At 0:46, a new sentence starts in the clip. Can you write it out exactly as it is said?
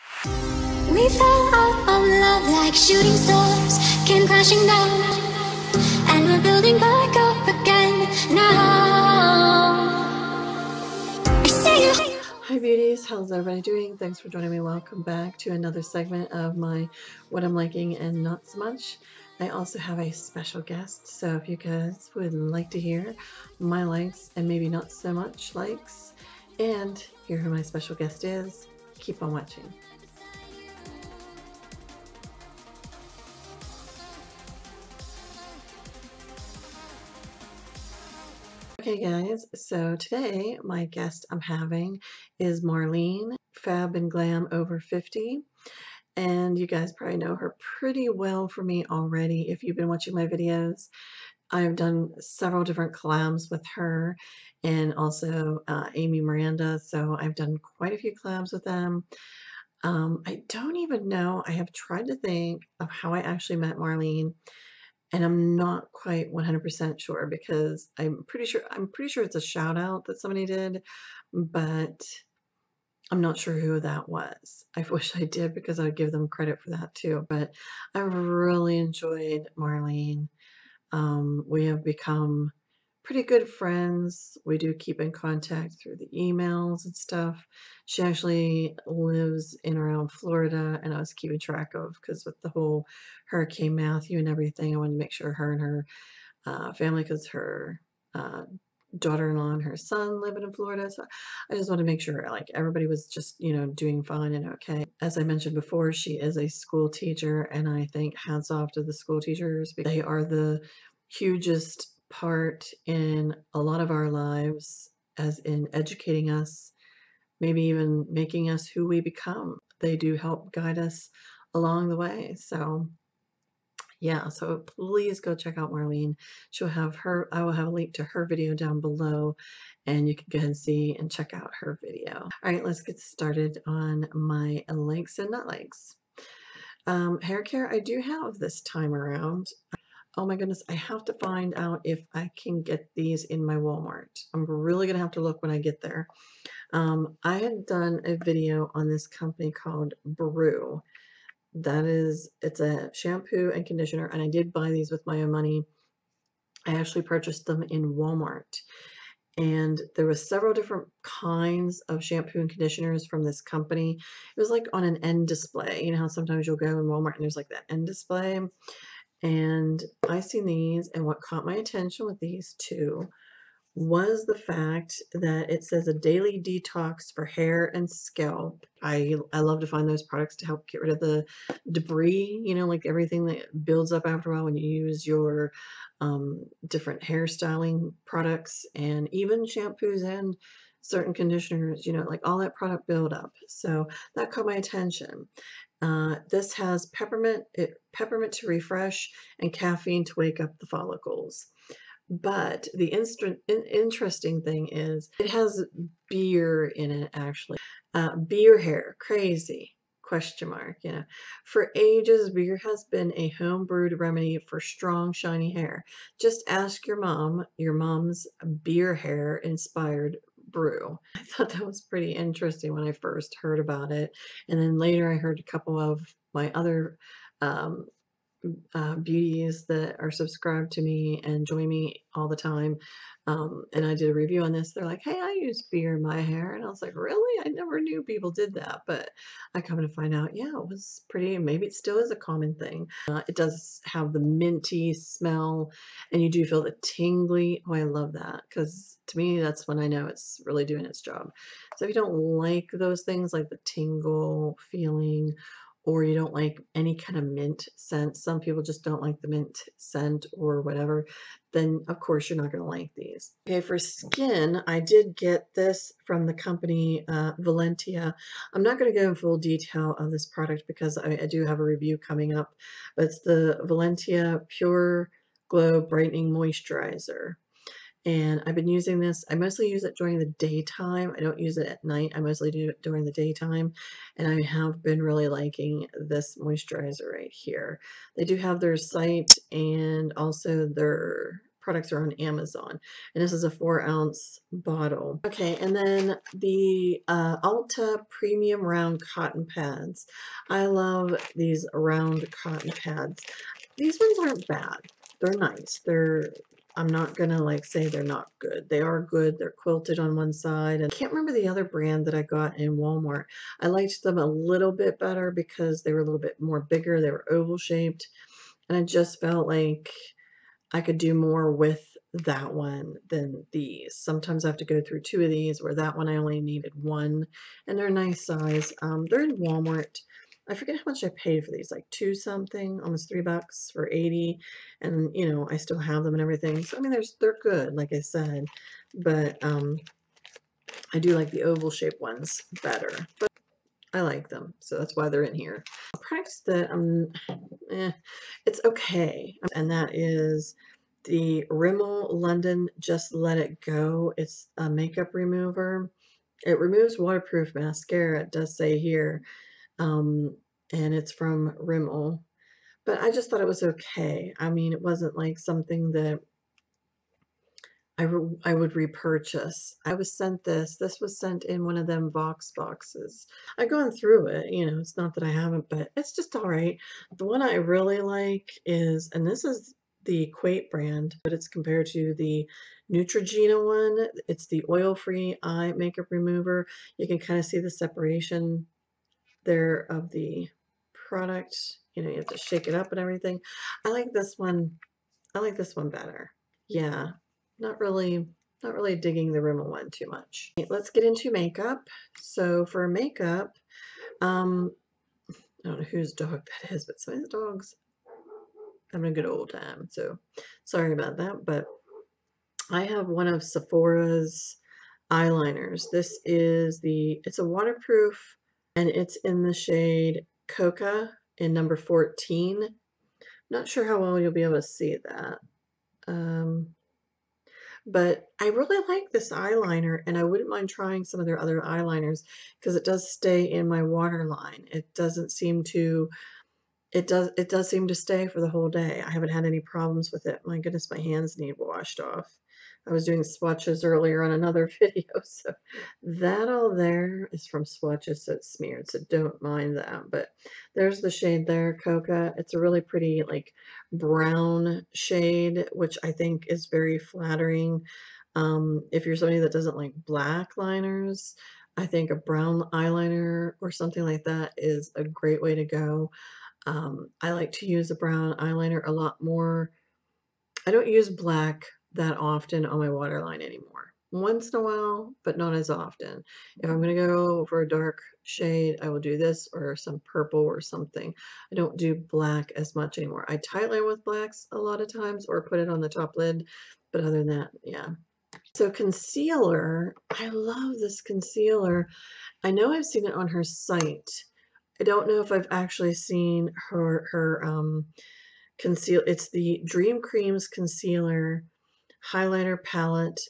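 And you guys probably know her pretty well for me already if you've been watching my videos.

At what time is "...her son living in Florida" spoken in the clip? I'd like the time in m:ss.
1:39.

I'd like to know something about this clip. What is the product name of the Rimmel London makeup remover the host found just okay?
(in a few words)
Just Let It Go.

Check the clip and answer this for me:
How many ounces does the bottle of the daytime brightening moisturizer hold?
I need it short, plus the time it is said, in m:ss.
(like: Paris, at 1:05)
4, at 4:53.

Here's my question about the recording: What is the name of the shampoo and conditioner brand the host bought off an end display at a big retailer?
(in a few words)
Broo.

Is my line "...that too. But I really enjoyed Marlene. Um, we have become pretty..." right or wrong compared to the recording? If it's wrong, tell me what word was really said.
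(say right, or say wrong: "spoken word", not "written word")
right.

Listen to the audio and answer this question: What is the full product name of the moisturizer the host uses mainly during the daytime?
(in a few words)
Valentia Pure Glow Brightening Moisturizer.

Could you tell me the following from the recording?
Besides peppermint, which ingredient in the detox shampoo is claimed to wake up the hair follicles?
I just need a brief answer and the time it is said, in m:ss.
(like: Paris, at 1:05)
Caffeine, at 3:19.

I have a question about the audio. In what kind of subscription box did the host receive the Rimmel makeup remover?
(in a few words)
Vox boxes.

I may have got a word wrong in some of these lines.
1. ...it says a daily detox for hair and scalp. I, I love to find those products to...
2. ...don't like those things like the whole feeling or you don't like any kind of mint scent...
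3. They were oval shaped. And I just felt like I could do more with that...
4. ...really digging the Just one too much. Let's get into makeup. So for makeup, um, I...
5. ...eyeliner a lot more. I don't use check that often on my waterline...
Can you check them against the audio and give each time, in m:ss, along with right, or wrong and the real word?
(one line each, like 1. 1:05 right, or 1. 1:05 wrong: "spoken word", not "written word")
1. 2:55 right
2. 4:11 wrong: "tingle", not "whole"
3. 5:16 right
4. 6:38 wrong: "Rimmel", not "Just"
5. 7:48 wrong: "black", not "check".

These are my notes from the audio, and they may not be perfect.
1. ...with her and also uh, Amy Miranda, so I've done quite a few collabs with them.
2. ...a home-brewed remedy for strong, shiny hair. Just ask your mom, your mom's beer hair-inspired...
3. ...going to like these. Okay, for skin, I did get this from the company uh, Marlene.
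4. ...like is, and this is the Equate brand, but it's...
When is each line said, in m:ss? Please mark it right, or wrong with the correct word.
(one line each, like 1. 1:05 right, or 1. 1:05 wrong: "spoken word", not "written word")
1. 0:53 right
2. 3:33 right
3. 4:22 wrong: "Valentia", not "Marlene"
4. 6:18 right.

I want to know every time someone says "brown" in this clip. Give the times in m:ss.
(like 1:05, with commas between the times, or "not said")
7:33, 7:42, 7:47.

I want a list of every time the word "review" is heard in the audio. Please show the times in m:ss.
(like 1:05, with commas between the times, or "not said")
3:54, 4:31.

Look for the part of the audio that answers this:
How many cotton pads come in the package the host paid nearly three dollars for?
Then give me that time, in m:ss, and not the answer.
5:33.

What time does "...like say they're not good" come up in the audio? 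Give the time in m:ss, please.
5:07.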